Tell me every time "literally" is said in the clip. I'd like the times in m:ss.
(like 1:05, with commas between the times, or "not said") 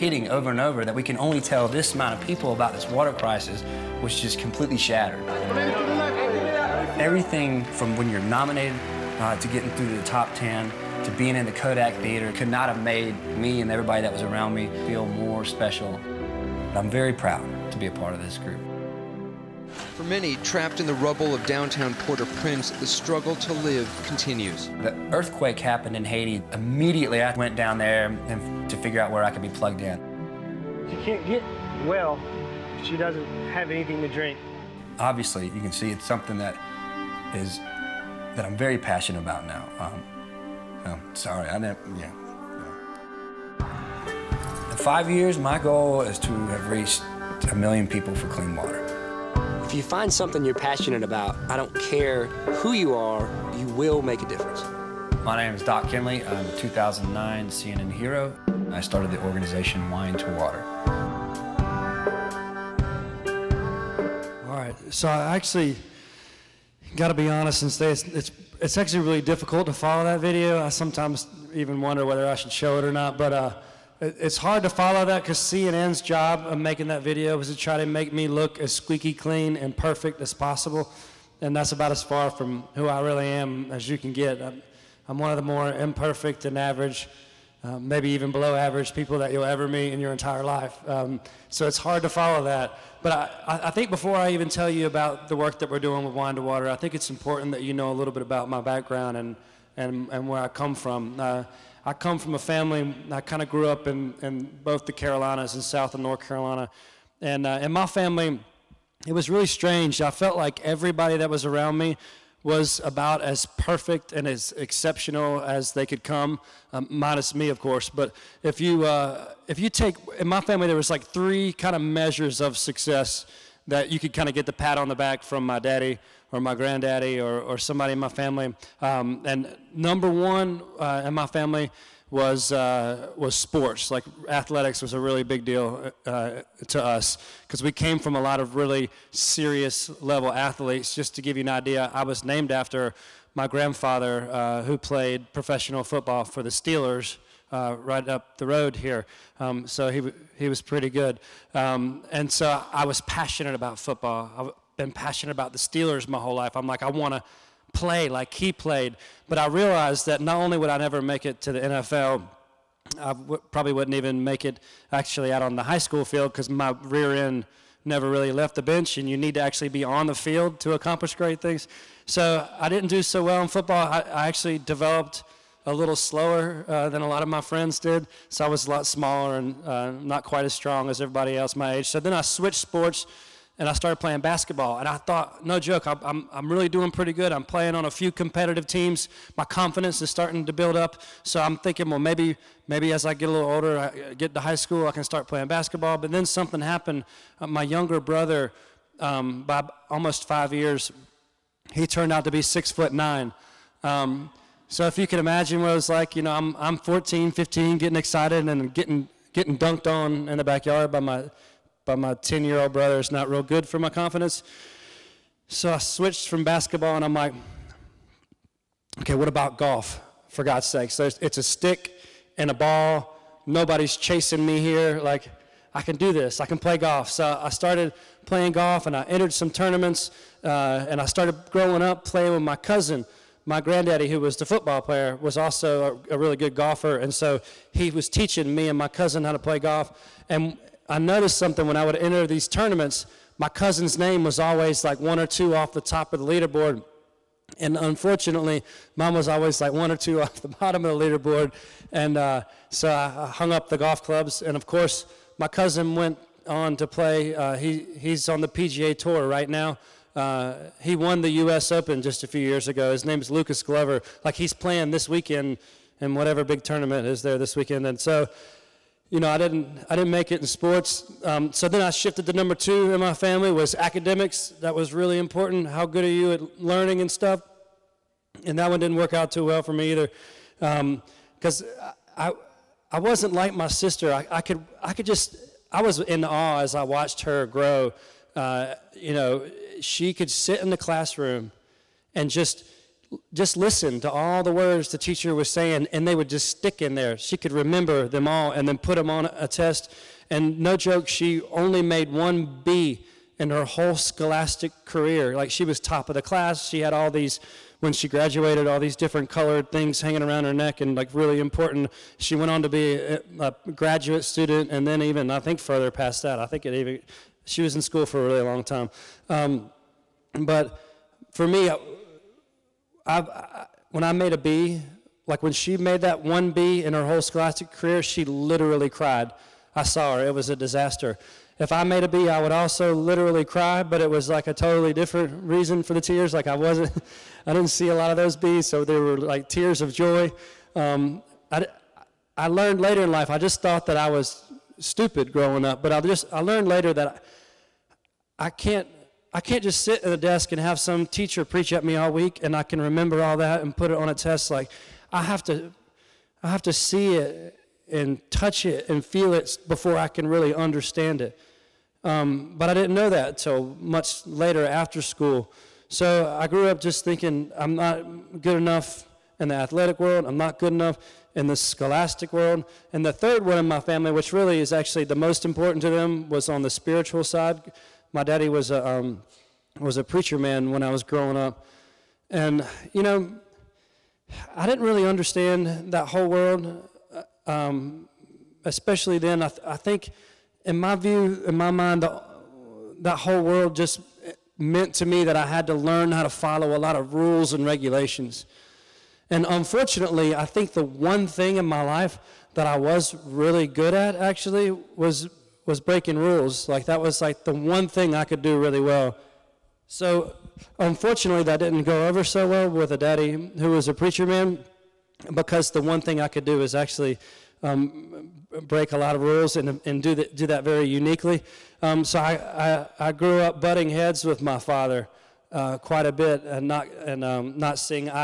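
5:28, 5:32.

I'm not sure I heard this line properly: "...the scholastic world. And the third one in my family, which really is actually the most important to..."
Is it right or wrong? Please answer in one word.
right.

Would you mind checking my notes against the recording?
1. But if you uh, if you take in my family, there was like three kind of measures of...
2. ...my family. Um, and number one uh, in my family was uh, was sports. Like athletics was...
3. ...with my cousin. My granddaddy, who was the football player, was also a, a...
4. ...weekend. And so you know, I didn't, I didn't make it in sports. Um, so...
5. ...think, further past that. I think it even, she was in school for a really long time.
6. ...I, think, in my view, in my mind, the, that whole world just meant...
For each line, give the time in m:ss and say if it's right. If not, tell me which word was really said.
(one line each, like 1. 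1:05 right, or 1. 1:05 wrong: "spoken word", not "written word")
1. 1:57 right
2. 2:07 right
3. 3:52 right
4. 4:27 right
5. 5:15 right
6. 6:29 right.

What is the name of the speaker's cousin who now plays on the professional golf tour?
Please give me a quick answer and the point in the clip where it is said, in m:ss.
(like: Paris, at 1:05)
Lucas Glover, at 4:23.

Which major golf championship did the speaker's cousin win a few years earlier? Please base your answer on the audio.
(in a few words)
U.S. Open.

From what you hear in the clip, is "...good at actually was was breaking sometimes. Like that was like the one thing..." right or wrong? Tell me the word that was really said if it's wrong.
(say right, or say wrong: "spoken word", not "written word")
wrong: "rules", not "sometimes".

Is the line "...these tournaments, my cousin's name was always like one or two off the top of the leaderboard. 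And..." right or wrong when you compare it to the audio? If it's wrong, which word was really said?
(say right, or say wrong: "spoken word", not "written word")
right.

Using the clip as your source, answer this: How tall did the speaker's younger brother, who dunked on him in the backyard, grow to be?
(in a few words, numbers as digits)
six foot nine.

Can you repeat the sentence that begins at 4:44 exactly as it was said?
I, I could, I could just, I was in awe as I watched her grow.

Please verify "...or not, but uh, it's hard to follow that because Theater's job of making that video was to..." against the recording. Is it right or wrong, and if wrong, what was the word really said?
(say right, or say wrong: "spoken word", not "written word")
wrong: "CNN", not "Theater".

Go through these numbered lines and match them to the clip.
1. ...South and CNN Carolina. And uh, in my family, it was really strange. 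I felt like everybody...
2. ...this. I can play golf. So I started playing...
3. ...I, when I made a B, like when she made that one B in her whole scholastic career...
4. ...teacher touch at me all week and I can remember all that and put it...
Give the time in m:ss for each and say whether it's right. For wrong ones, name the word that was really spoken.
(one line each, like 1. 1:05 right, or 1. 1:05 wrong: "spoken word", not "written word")
1. 1:45 wrong: "North", not "CNN"
2. 3:46 right
3. 5:23 right
4. 5:51 wrong: "preach", not "touch".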